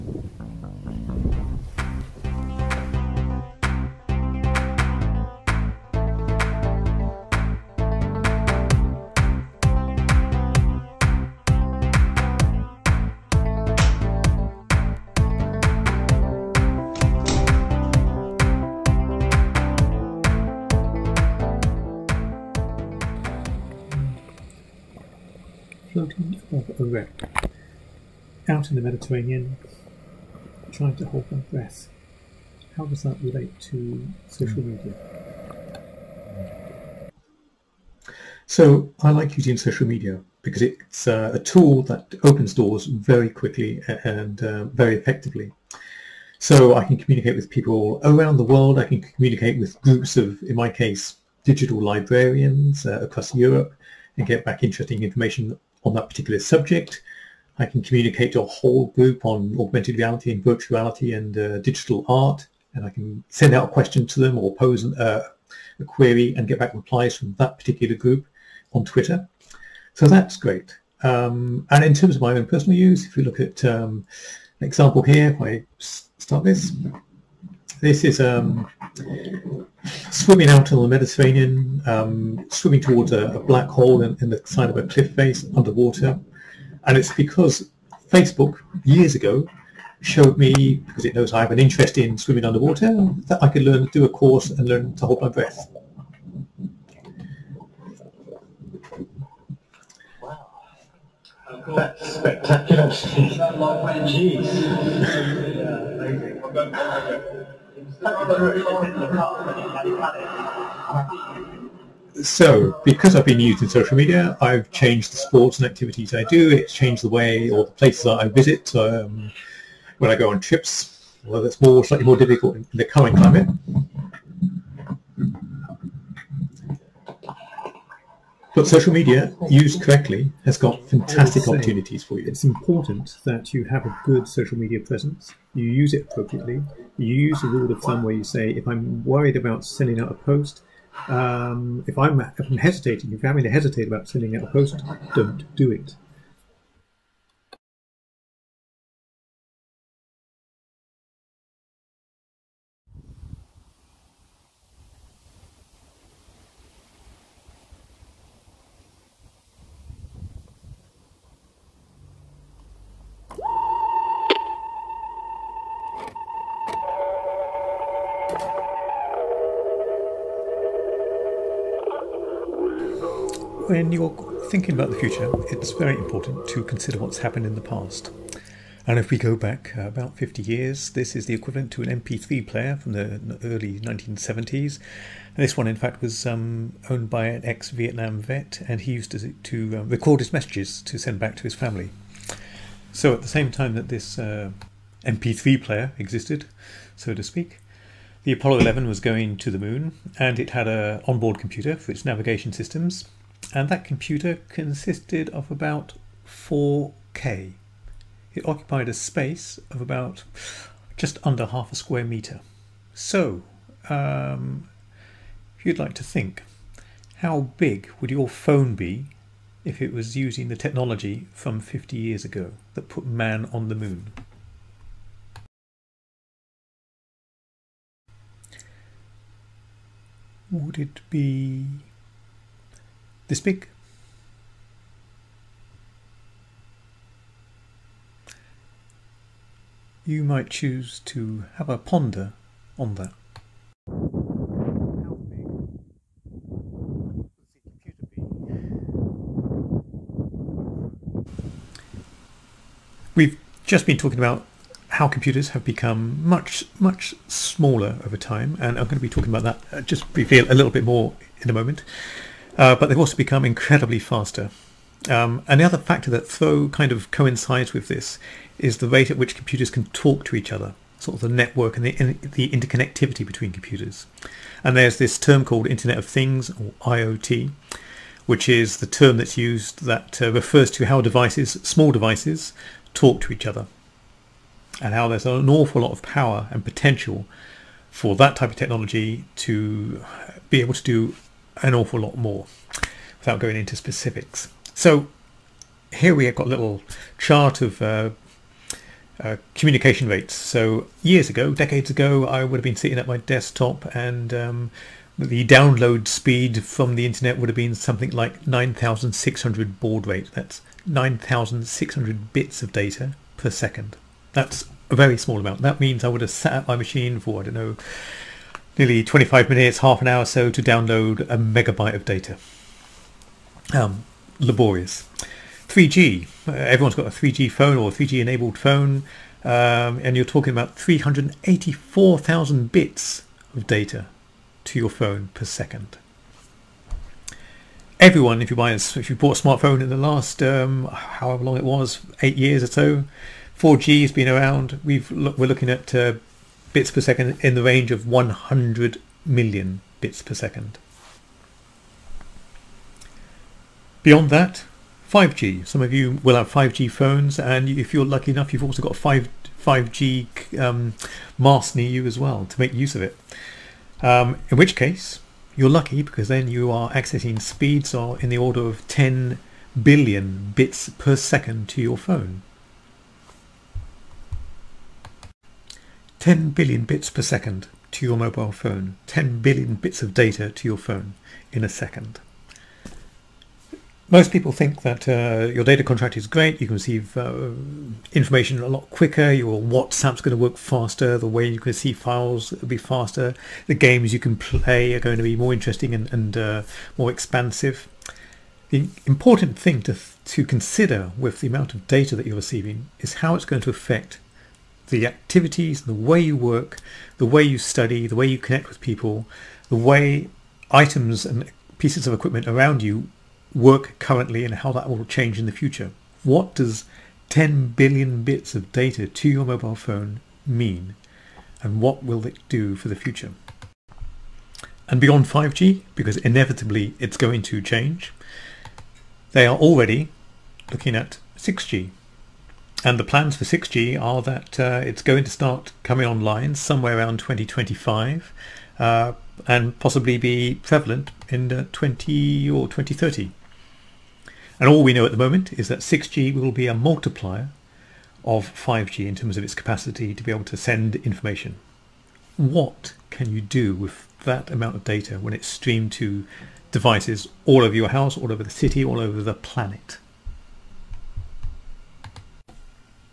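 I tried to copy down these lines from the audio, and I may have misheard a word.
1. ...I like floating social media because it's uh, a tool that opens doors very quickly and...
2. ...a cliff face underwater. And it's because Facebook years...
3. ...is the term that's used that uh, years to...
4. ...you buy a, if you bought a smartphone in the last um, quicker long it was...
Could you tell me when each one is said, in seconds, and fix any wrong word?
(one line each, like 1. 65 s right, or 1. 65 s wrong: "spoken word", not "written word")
1. 39 s wrong: "using", not "floating"
2. 84 s right
3. 278 s wrong: "refers", not "years"
4. 338 s wrong: "however", not "quicker".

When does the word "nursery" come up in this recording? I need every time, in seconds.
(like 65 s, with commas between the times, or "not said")
not said.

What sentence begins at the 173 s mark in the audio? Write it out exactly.
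when you're thinking about the future, it's very important to consider what's happened in the past.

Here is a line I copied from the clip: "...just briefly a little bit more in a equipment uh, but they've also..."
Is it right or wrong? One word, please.
wrong.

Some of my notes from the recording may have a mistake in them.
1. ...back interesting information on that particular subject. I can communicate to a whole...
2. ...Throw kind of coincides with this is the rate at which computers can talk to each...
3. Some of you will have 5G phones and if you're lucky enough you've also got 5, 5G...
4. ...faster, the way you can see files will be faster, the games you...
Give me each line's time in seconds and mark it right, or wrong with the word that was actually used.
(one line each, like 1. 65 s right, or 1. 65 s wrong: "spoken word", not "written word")
1. 54 s right
2. 266 s right
3. 355 s right
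4. 390 s right.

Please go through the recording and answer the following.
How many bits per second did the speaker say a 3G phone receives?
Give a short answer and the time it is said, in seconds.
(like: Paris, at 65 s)
384,000, at 330 s.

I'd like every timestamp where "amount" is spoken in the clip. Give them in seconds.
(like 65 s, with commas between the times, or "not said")
315 s, 401 s, 454 s.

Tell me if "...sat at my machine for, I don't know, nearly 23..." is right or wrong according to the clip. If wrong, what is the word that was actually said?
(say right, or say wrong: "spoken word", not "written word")
wrong: "25", not "23".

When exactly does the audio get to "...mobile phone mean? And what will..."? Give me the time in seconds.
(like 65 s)
419 s.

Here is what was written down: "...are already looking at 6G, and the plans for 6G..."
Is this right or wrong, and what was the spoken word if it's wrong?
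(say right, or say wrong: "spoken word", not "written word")
right.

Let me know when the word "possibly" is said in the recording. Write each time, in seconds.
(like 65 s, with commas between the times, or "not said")
439 s.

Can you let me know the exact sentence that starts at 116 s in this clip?
It's changed the way or the places that I visit.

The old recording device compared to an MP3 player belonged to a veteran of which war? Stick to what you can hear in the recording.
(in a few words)
Vietnam.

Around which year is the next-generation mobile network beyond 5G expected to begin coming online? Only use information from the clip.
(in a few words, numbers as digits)
2025.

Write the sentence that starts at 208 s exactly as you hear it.
It occupied a space of about just under half a square meter.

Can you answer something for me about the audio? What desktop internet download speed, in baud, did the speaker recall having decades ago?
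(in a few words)
9,600.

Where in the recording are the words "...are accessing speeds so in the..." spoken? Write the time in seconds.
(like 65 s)
366 s.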